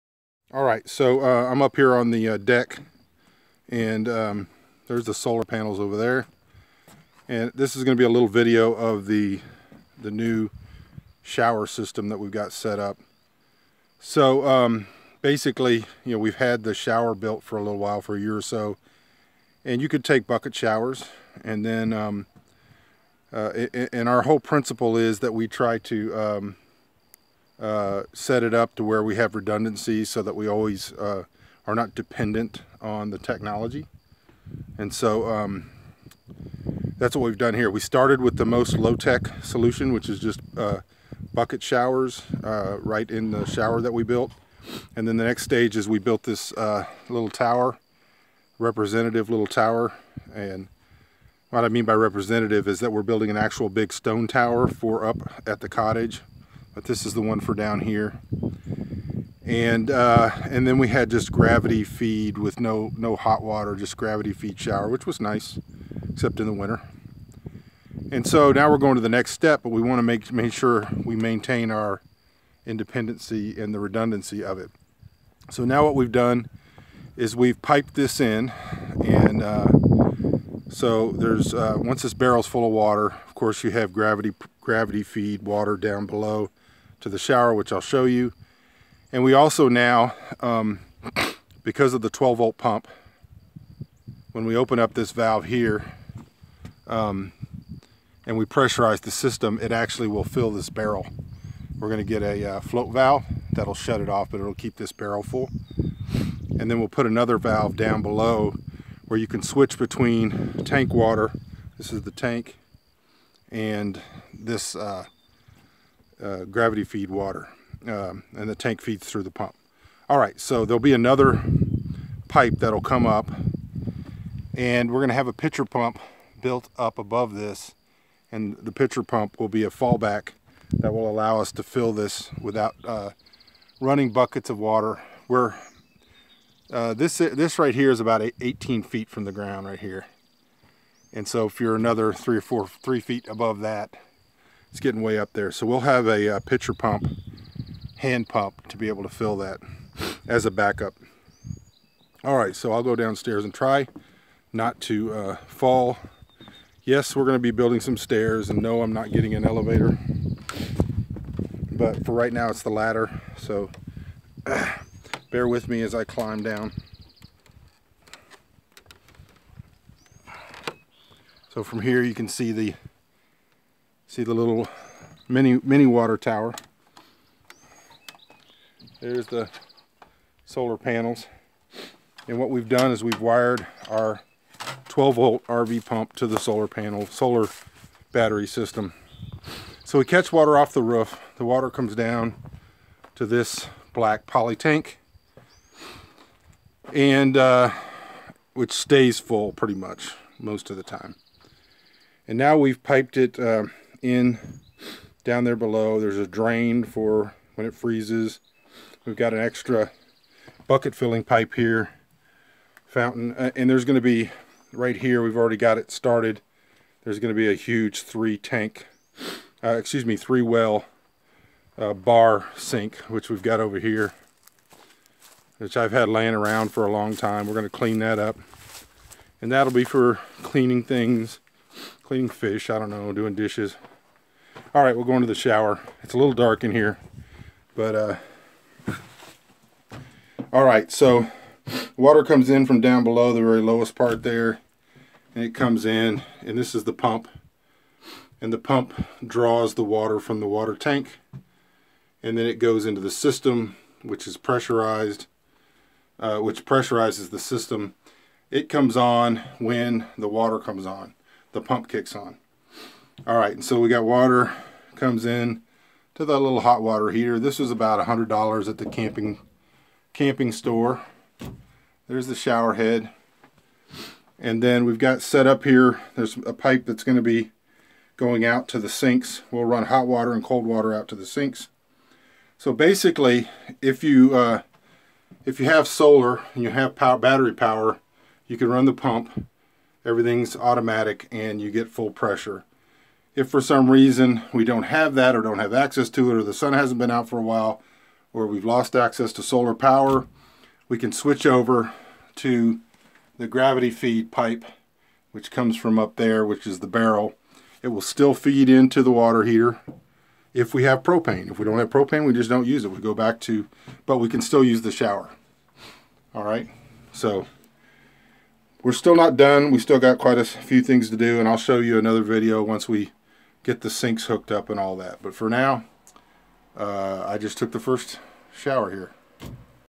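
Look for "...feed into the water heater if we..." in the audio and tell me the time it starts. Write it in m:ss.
5:08.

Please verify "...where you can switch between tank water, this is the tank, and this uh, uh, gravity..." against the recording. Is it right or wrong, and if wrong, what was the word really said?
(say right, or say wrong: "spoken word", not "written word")
right.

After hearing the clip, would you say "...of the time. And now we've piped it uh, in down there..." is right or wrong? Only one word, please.
right.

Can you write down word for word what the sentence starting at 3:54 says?
All right, we'll go into the shower.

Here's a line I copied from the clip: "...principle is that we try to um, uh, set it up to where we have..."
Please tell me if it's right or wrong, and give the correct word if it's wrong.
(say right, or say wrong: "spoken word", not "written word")
right.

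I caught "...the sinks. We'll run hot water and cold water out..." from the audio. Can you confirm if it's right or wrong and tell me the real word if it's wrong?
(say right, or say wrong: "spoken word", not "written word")
right.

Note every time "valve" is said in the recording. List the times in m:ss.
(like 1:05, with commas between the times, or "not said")
1:35, 1:42, 1:47.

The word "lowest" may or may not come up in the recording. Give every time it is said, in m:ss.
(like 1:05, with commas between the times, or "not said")
4:03.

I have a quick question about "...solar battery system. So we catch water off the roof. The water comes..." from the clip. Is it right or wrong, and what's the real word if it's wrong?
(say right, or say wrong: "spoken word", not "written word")
right.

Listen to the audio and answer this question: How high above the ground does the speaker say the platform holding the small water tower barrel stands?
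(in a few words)
18 feet.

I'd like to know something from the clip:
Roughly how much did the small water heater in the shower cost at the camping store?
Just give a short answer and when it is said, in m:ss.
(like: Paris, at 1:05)
$100, at 4:28.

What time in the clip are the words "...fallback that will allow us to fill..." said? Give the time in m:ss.
2:09.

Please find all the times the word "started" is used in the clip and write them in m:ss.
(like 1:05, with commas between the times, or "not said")
0:37, 3:35.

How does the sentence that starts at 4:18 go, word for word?
It comes on when the water comes on.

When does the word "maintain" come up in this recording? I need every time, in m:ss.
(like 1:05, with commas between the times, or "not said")
1:11.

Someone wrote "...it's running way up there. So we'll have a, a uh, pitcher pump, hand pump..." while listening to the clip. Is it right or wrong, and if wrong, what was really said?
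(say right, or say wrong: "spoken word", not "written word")
wrong: "getting", not "running".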